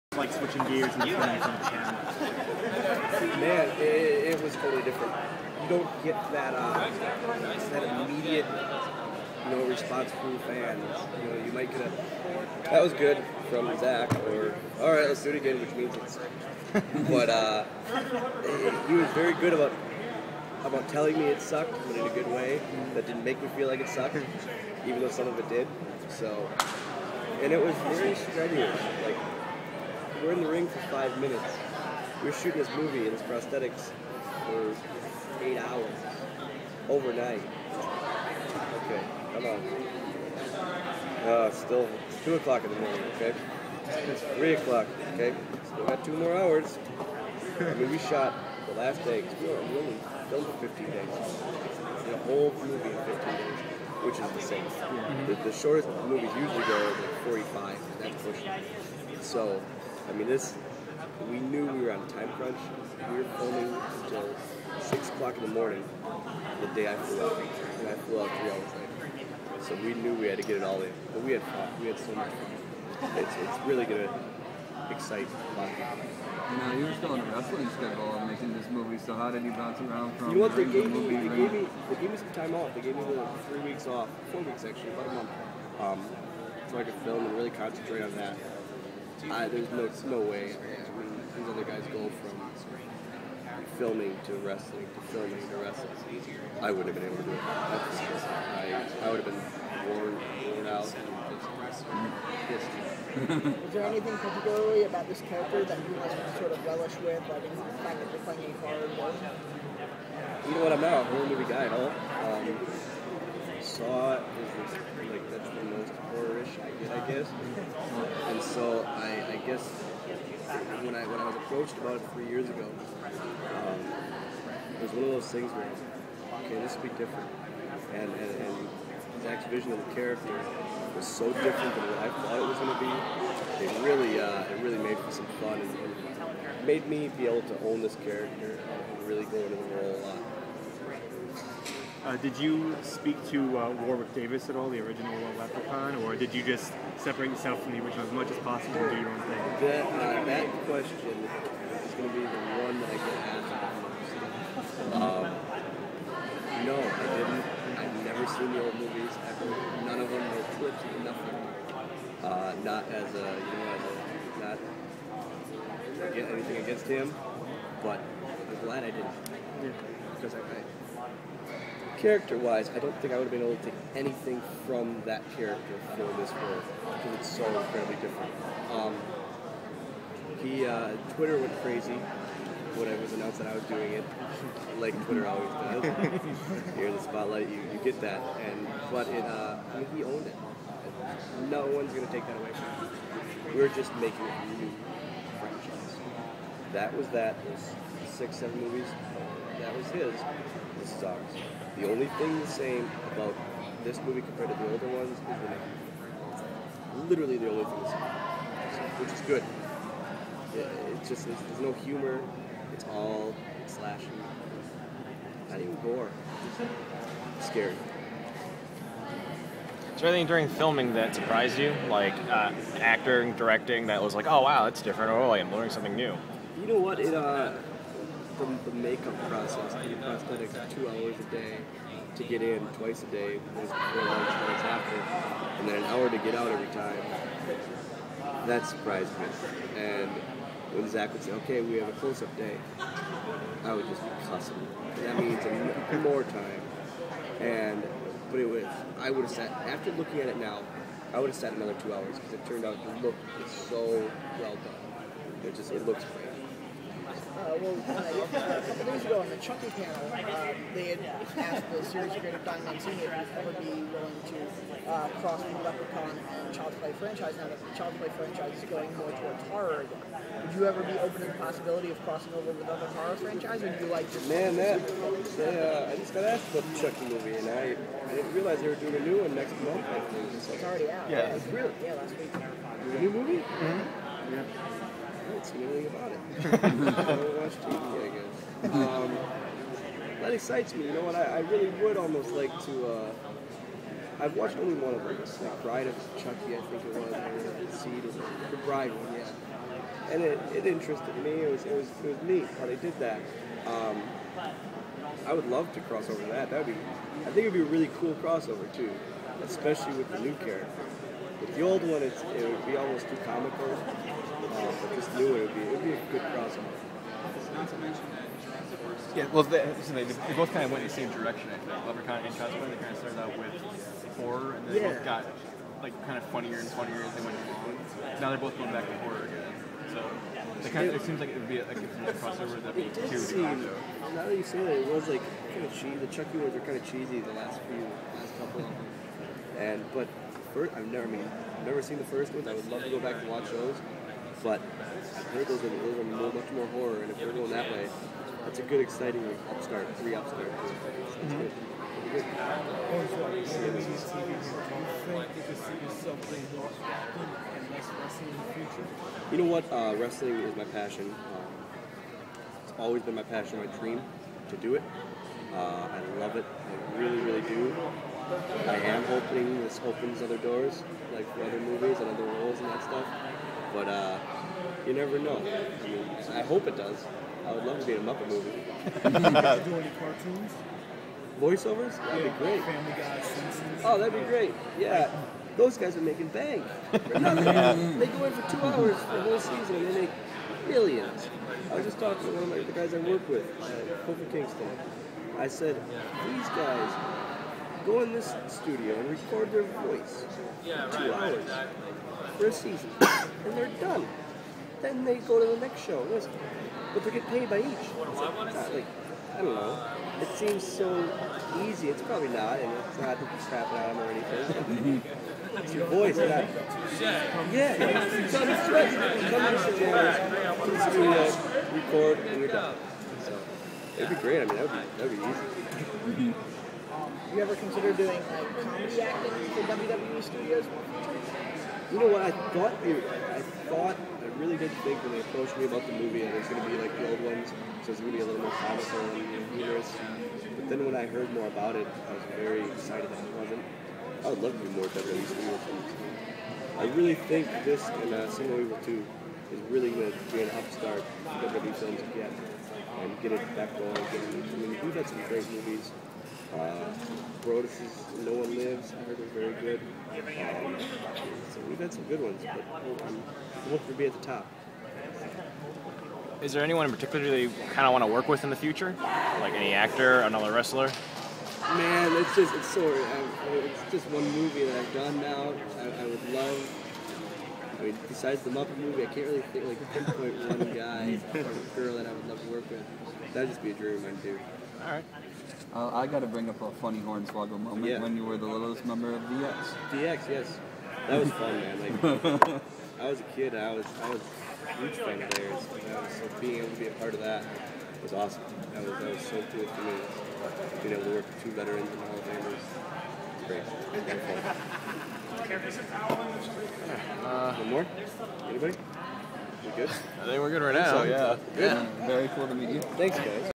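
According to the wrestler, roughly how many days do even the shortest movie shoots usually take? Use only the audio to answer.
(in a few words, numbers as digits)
45.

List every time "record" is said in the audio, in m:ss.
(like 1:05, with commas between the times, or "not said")
6:39, 7:01.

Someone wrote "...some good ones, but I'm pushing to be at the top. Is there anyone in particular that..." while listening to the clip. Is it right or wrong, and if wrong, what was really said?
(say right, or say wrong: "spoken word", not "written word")
wrong: "looking", not "pushing".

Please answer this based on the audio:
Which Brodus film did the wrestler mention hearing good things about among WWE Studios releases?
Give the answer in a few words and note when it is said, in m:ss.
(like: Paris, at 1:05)
No One Lives, at 7:38.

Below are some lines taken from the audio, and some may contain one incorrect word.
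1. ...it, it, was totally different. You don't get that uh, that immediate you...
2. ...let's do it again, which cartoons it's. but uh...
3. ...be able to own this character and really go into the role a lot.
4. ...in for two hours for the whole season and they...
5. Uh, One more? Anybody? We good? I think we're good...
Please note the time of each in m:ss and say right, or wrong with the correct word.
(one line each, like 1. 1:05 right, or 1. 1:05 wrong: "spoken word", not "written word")
1. 0:03 right
2. 0:15 wrong: "means", not "cartoons"
3. 2:17 right
4. 6:28 right
5. 8:27 right.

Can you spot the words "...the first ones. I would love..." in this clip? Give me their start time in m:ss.
5:41.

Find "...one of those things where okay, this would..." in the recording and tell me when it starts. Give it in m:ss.
2:04.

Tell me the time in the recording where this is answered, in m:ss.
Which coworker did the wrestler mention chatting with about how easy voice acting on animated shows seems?
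6:34.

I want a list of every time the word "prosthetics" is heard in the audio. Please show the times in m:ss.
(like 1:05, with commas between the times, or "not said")
0:33, 3:49.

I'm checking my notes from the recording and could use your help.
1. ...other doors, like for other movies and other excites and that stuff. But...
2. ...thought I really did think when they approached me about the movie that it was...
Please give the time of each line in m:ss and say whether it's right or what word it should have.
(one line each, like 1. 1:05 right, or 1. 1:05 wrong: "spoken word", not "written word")
1. 6:10 wrong: "roles", not "excites"
2. 7:13 right.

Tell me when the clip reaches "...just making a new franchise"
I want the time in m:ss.
3:13.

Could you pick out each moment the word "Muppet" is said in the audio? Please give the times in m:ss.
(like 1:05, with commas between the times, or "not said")
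6:18, 7:58.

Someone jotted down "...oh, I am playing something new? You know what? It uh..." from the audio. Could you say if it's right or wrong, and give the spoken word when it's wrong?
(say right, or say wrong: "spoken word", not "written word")
wrong: "learning", not "playing".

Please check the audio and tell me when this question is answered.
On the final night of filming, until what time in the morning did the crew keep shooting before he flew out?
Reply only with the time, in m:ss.
1:04.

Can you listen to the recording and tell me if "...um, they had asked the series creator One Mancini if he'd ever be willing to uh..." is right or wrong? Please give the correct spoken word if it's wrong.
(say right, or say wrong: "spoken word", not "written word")
wrong: "Don", not "One".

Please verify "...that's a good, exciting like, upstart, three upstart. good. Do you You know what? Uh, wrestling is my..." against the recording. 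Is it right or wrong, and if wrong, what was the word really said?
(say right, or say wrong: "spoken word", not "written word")
right.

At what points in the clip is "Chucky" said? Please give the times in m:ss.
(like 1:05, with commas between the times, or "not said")
4:19, 4:36, 4:56, 5:36.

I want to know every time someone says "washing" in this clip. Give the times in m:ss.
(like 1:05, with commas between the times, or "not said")
not said.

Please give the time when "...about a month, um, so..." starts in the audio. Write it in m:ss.
1:24.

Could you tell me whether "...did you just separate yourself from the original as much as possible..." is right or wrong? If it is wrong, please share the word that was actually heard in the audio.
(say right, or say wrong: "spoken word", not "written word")
right.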